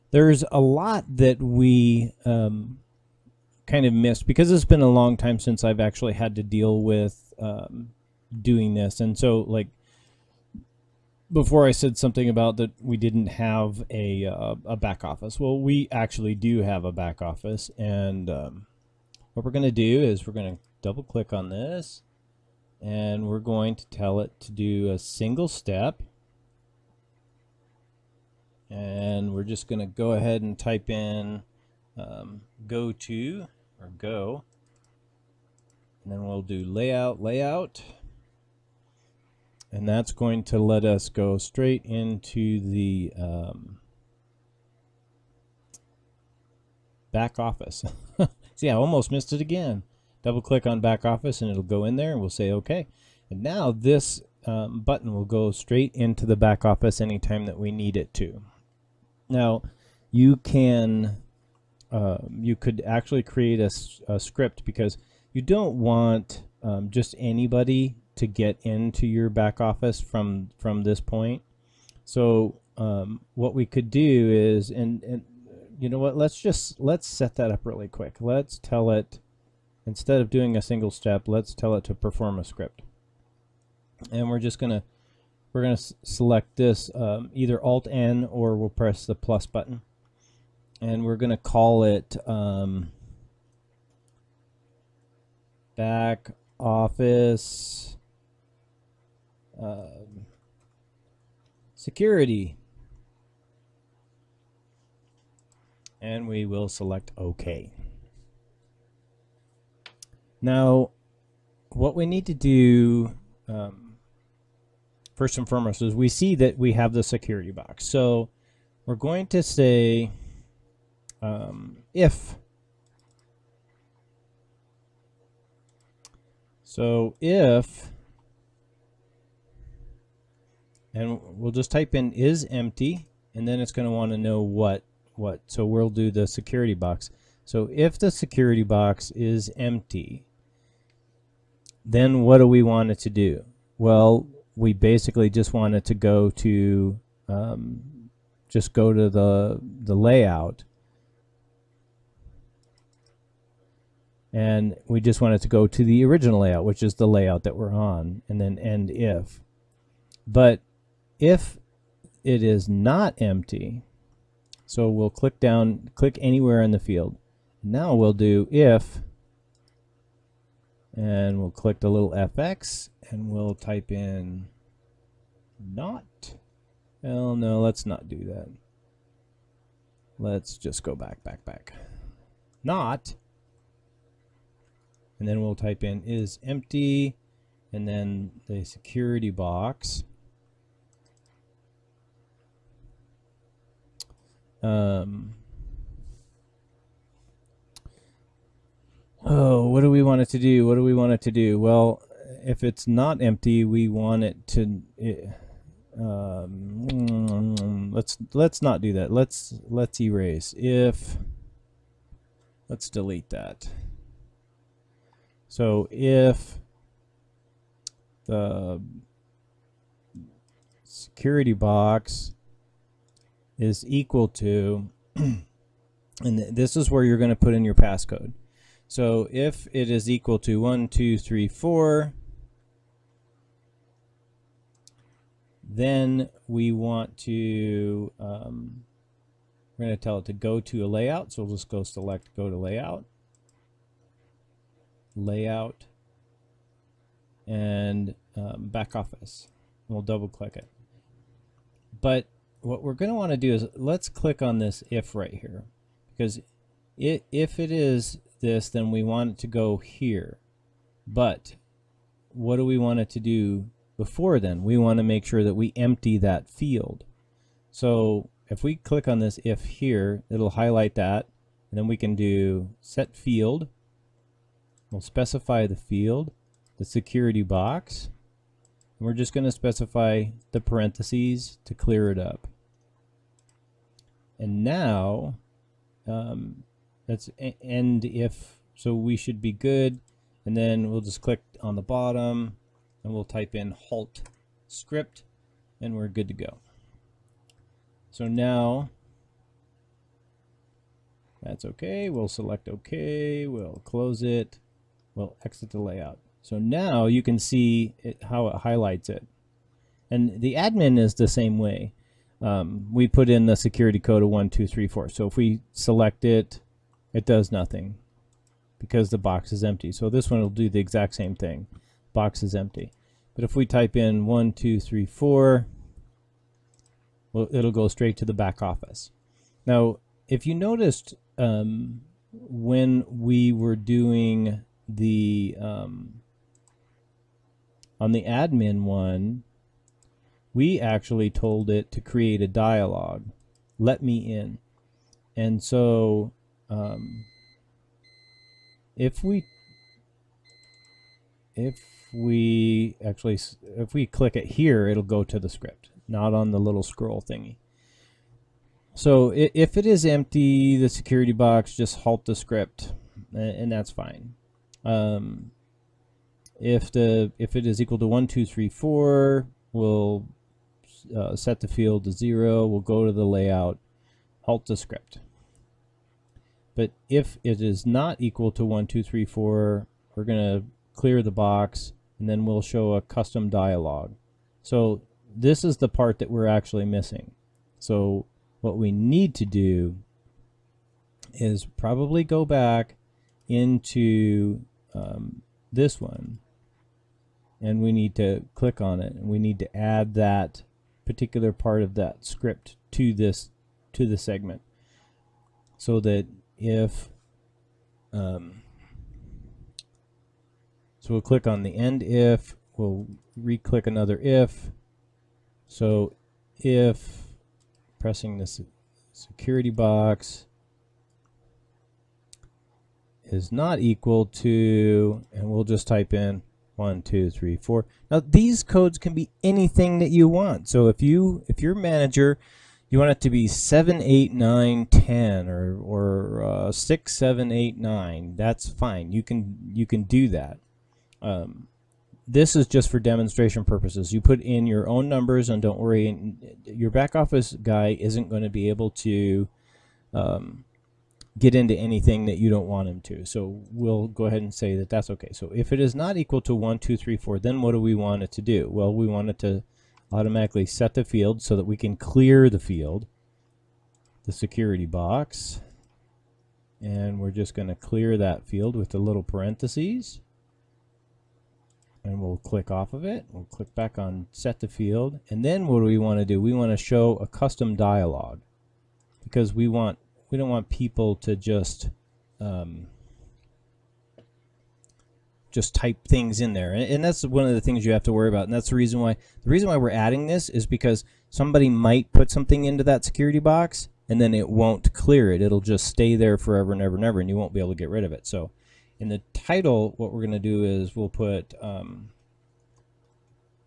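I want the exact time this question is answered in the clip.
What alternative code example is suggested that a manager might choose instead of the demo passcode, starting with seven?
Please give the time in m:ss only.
7:13.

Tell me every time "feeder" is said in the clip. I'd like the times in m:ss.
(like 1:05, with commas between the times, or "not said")
not said.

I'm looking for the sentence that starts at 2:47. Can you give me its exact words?
Now we'll do if, and we'll click the little fx, and we'll type in not.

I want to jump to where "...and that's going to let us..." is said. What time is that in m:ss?
0:39.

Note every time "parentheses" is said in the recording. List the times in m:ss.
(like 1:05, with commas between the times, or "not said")
4:40, 7:49.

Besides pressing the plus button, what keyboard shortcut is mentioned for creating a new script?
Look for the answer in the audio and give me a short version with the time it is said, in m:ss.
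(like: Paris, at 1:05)
Alt N, at 1:27.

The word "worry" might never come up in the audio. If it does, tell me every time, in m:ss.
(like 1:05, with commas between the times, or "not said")
7:25, 8:08.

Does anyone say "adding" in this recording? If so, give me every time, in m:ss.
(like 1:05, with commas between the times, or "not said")
8:09.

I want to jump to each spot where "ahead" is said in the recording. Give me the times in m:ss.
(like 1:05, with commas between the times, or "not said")
0:30, 7:34.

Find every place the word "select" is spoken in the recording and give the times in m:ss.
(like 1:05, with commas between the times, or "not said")
1:26, 1:46, 4:01, 5:02, 5:15.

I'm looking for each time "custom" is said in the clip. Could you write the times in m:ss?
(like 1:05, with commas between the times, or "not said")
6:23, 7:57.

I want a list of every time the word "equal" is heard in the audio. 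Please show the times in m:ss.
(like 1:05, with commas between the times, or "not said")
3:43, 3:50, 6:07, 6:18, 7:03, 7:36.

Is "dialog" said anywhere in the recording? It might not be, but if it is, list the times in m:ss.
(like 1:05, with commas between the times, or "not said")
5:42, 6:23, 7:57.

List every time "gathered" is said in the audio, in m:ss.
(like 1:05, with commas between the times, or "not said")
not said.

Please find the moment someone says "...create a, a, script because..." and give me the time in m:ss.
1:03.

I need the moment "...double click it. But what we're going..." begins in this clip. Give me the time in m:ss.
4:10.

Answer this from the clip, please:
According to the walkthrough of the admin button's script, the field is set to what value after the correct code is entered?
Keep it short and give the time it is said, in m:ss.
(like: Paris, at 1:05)
0, at 6:12.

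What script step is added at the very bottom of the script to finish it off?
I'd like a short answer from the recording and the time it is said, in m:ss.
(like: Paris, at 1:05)
halt script, at 4:53.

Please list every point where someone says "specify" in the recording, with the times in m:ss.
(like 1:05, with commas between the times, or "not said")
4:35, 4:39.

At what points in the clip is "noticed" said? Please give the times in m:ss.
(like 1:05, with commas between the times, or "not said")
5:30.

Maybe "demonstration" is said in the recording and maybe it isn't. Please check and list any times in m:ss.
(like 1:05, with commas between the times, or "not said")
7:22.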